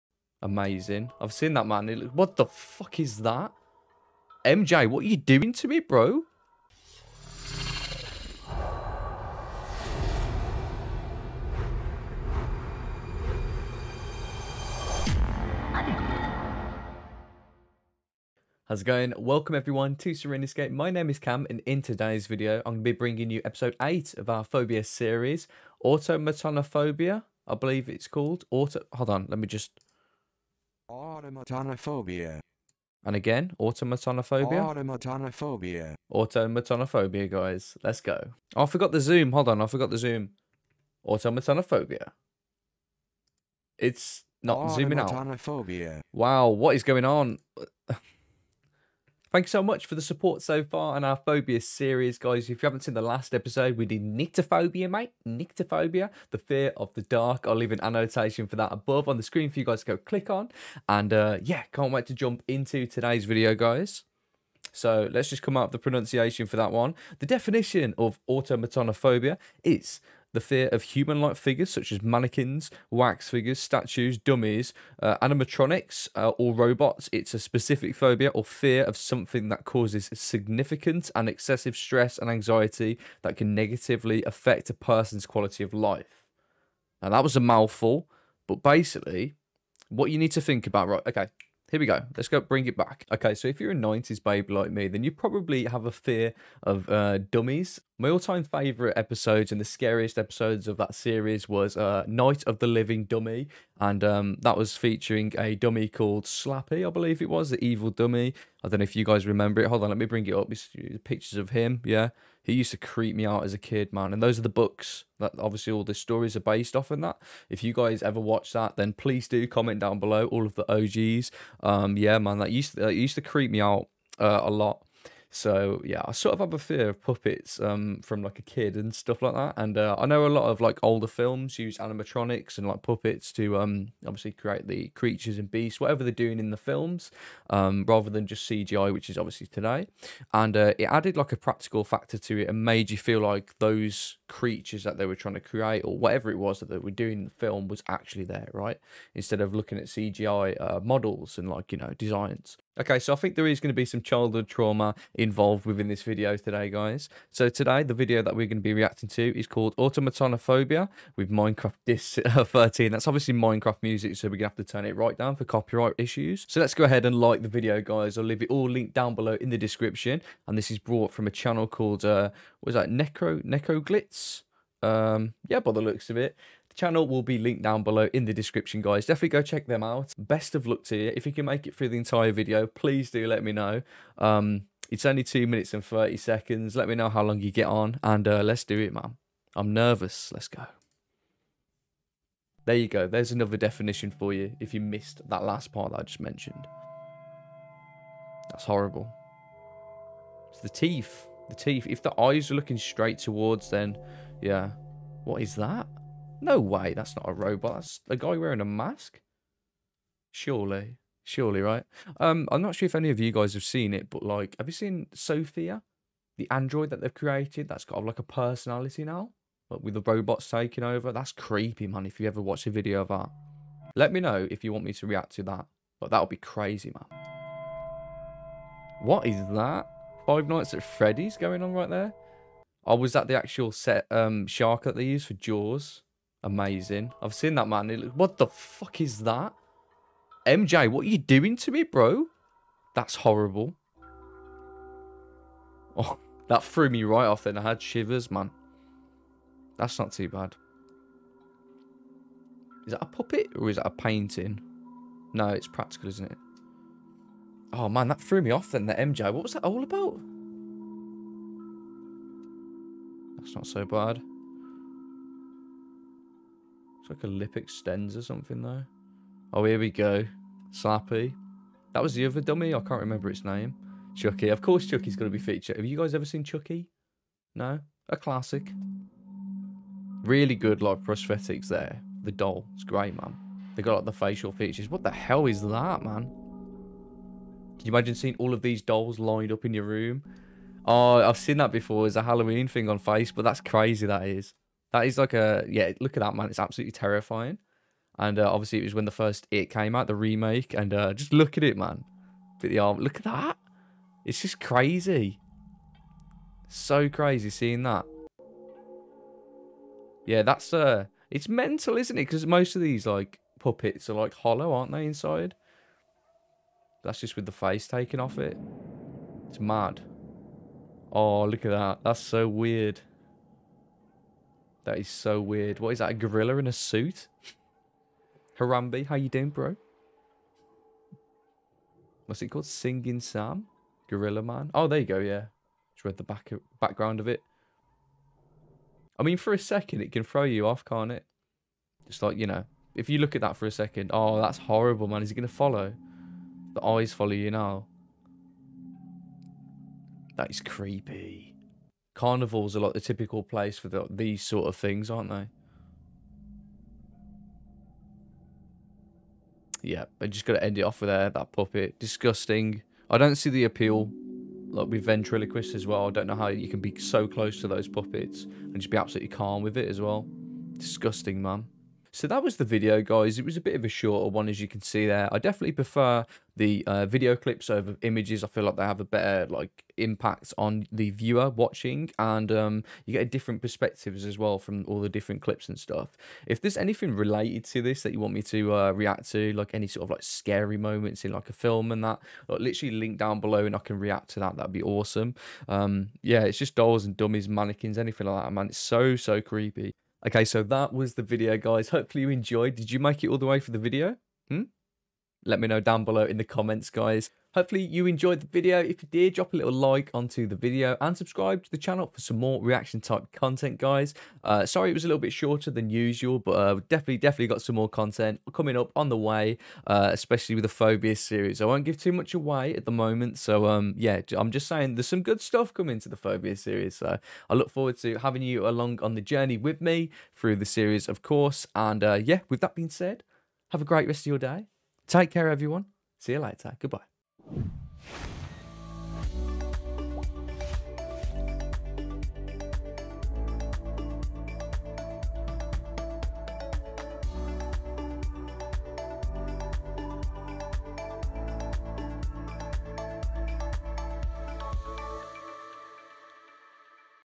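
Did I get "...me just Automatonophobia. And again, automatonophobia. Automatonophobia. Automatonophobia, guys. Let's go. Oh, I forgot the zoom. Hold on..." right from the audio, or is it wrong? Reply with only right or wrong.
right.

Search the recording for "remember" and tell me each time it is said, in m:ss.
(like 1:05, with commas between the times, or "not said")
1:49, 4:33.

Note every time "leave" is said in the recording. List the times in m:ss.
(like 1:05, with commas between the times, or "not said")
0:57, 2:48.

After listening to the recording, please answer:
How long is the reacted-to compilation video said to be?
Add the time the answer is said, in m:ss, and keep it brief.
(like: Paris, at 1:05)
2 minutes 30 seconds, at 3:05.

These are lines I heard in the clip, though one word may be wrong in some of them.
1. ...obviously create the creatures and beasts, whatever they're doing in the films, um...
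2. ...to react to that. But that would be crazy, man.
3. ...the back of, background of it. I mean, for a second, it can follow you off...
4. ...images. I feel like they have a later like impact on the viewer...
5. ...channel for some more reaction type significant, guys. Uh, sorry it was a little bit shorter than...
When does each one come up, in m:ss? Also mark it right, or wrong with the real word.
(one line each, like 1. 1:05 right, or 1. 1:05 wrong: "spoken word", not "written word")
1. 2:14 right
2. 3:44 right
3. 5:36 wrong: "throw", not "follow"
4. 6:18 wrong: "better", not "later"
5. 6:51 wrong: "content", not "significant".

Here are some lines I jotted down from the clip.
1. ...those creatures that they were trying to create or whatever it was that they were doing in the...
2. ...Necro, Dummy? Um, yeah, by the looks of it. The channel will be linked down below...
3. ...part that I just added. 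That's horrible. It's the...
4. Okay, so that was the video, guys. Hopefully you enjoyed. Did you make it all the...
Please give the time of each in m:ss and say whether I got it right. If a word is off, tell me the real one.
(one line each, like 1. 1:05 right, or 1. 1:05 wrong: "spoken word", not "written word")
1. 2:23 right
2. 2:52 wrong: "Necroglitz", not "Dummy"
3. 3:15 wrong: "mentioned", not "added"
4. 6:40 right.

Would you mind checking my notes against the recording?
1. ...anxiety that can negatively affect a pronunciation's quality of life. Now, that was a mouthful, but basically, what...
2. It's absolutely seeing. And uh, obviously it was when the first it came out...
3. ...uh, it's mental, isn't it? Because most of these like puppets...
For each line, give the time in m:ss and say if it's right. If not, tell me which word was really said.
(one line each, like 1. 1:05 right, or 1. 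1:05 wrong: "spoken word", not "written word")
1. 1:22 wrong: "person", not "pronunciation"
2. 4:56 wrong: "terrifying", not "seeing"
3. 5:10 right.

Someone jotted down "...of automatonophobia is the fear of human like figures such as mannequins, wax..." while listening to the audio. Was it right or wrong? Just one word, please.
right.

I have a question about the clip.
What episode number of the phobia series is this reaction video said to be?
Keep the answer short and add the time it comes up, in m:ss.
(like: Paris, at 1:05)
8, at 0:23.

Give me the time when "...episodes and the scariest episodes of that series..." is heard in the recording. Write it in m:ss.
1:38.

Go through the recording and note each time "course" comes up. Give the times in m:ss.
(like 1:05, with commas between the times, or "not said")
4:34, 7:11.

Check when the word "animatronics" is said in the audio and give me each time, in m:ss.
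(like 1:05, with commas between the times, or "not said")
1:15, 2:11.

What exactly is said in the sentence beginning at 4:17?
Oh, man, that threw me off then, the MJ.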